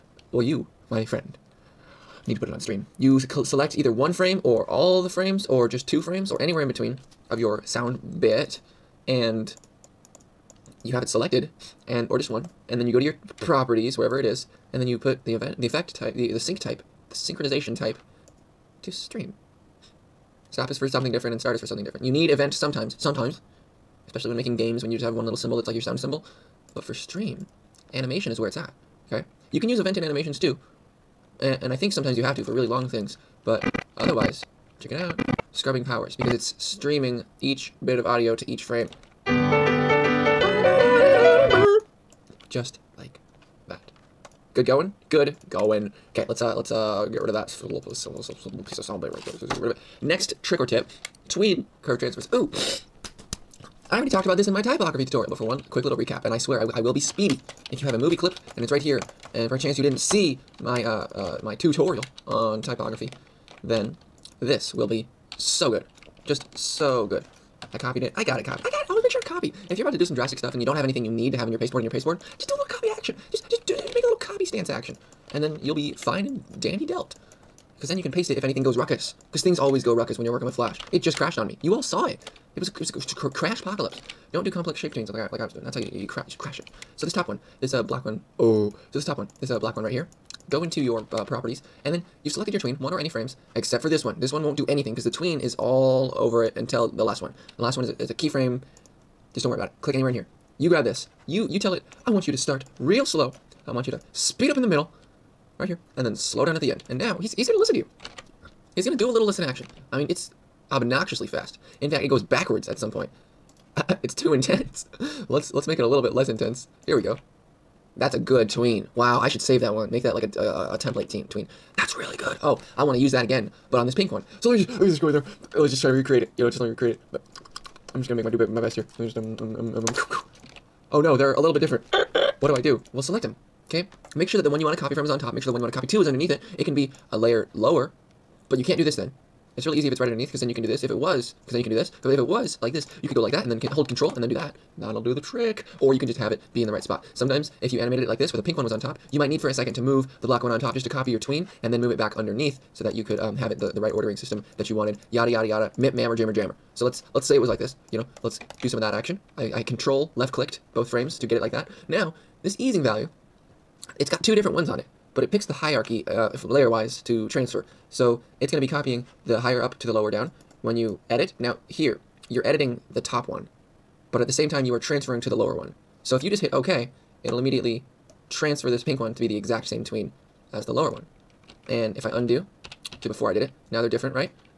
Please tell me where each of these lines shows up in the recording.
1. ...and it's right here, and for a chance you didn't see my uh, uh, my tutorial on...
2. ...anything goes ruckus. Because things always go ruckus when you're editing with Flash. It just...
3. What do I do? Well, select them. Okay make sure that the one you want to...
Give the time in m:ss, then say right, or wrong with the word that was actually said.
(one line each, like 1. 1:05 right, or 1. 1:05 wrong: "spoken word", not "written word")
1. 0:58 right
2. 1:18 wrong: "working", not "editing"
3. 2:12 right.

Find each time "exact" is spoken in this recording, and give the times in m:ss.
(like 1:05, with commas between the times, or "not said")
2:59.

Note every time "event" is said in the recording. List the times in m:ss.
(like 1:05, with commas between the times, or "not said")
0:15, 0:22, 0:29.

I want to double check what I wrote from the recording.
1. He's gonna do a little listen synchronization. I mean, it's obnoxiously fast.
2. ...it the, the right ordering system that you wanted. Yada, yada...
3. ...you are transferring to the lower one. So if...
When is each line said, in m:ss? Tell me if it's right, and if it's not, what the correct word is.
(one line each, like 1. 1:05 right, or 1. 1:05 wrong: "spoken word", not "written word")
1. 1:48 wrong: "action", not "synchronization"
2. 2:33 right
3. 2:54 right.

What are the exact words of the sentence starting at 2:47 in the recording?
So it's going to be copying the higher up to the lower down when you edit.